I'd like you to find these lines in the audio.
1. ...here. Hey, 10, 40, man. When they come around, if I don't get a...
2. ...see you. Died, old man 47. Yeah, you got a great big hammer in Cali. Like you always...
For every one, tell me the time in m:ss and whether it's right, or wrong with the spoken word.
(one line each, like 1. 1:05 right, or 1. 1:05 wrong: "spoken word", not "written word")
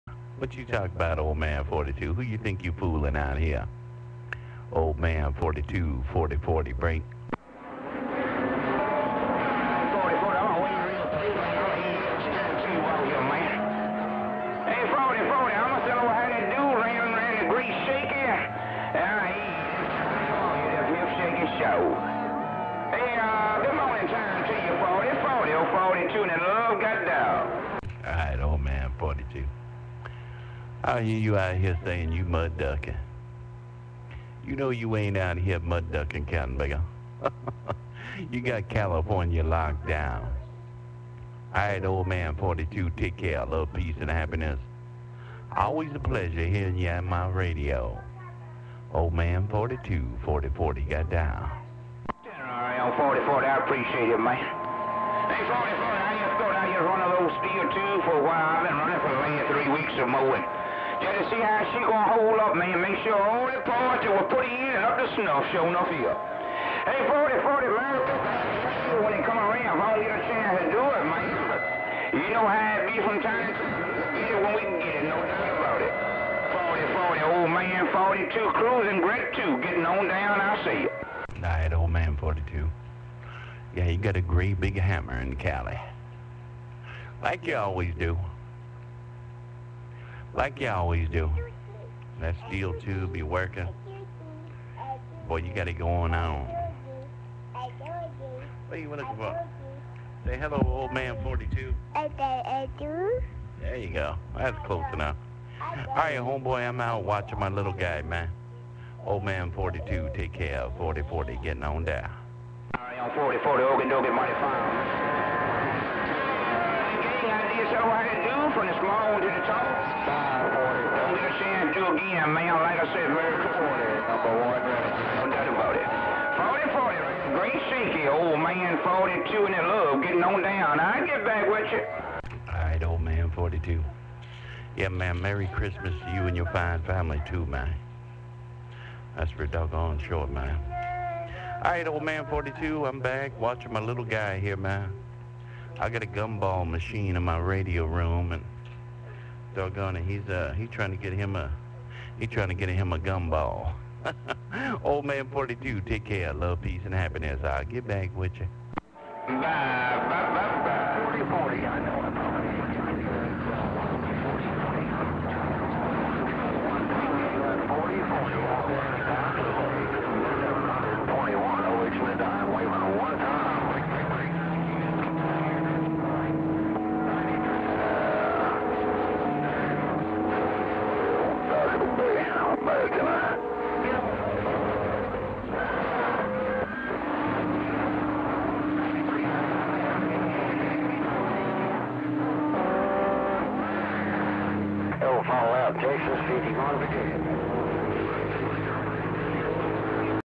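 1. 1:05 wrong: "40", not "10"
2. 1:20 wrong: "42", not "47".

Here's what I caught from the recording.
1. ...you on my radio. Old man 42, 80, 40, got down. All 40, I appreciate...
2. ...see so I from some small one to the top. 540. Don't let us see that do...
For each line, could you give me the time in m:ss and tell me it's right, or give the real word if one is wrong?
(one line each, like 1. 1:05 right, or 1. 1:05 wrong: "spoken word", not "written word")
1. 0:46 wrong: "40", not "80"
2. 1:57 right.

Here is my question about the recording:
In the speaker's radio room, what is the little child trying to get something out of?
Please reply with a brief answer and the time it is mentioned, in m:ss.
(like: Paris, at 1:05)
Gumball machine, at 2:26.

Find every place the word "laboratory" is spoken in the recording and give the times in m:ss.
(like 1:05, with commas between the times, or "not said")
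not said.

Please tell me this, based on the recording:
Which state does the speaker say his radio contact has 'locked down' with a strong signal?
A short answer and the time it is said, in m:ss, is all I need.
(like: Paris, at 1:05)
California, at 0:38.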